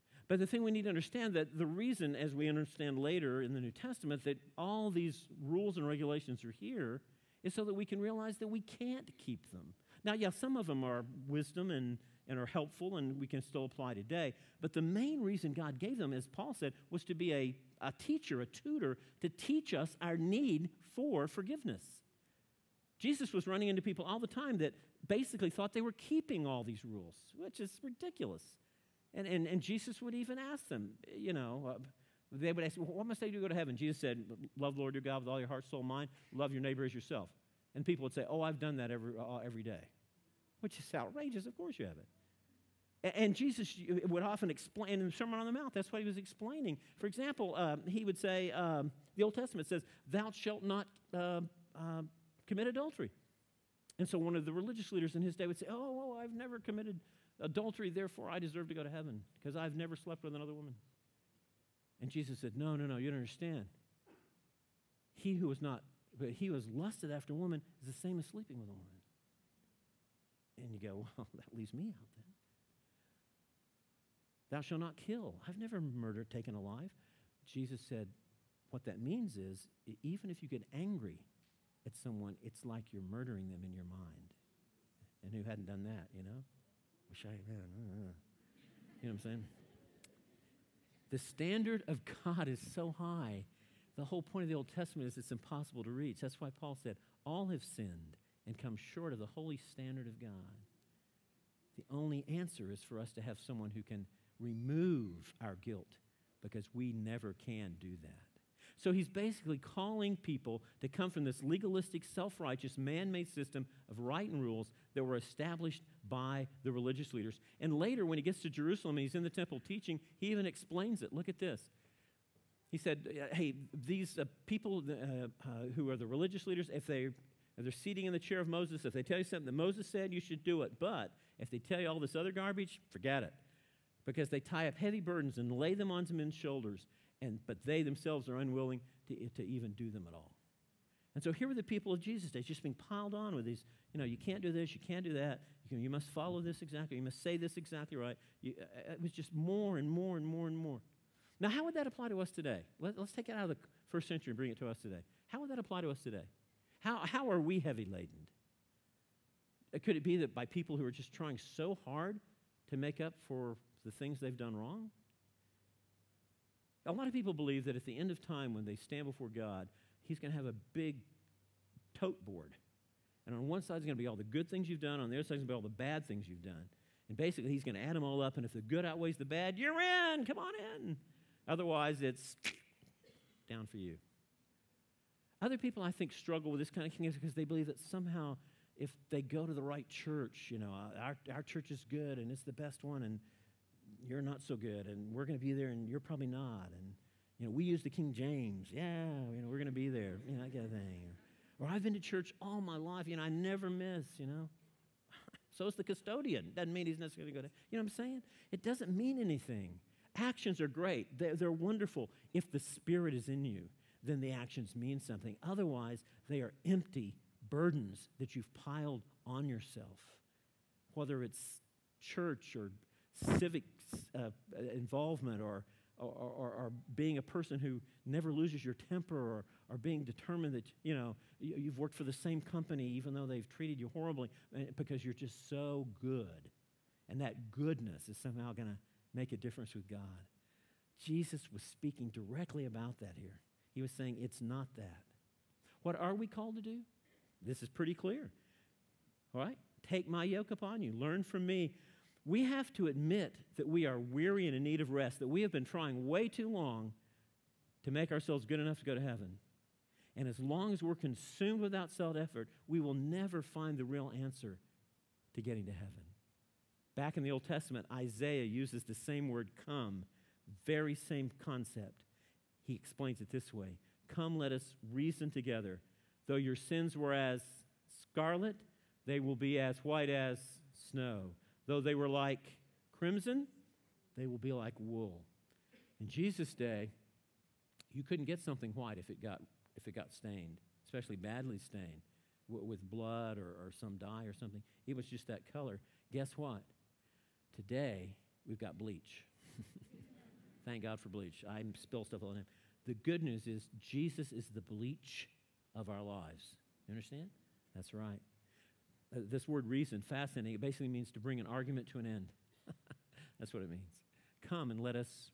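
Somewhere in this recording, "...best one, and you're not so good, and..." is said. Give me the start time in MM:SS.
03:12.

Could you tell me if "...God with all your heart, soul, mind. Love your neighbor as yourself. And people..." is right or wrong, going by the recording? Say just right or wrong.
right.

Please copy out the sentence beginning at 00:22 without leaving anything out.
Jesus was running into people all the time that basically thought they were keeping all these rules, which is ridiculous.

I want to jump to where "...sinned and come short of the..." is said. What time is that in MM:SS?
01:37.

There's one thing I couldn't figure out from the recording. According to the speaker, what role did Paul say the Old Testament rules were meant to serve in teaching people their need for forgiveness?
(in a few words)
a tutor.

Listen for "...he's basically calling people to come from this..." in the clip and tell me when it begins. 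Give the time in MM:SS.
01:48.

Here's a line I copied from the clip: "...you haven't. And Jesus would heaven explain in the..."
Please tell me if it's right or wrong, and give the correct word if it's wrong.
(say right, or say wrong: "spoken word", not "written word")
wrong: "often", not "heaven".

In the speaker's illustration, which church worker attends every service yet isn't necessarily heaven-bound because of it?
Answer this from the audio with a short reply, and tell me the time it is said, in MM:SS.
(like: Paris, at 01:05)
the custodian, at 03:25.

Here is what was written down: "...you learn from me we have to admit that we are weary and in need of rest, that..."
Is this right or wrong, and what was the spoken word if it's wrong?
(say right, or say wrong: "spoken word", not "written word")
right.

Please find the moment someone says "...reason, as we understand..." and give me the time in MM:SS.
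00:01.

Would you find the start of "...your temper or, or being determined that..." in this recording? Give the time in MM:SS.
03:48.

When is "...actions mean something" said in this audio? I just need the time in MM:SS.
03:34.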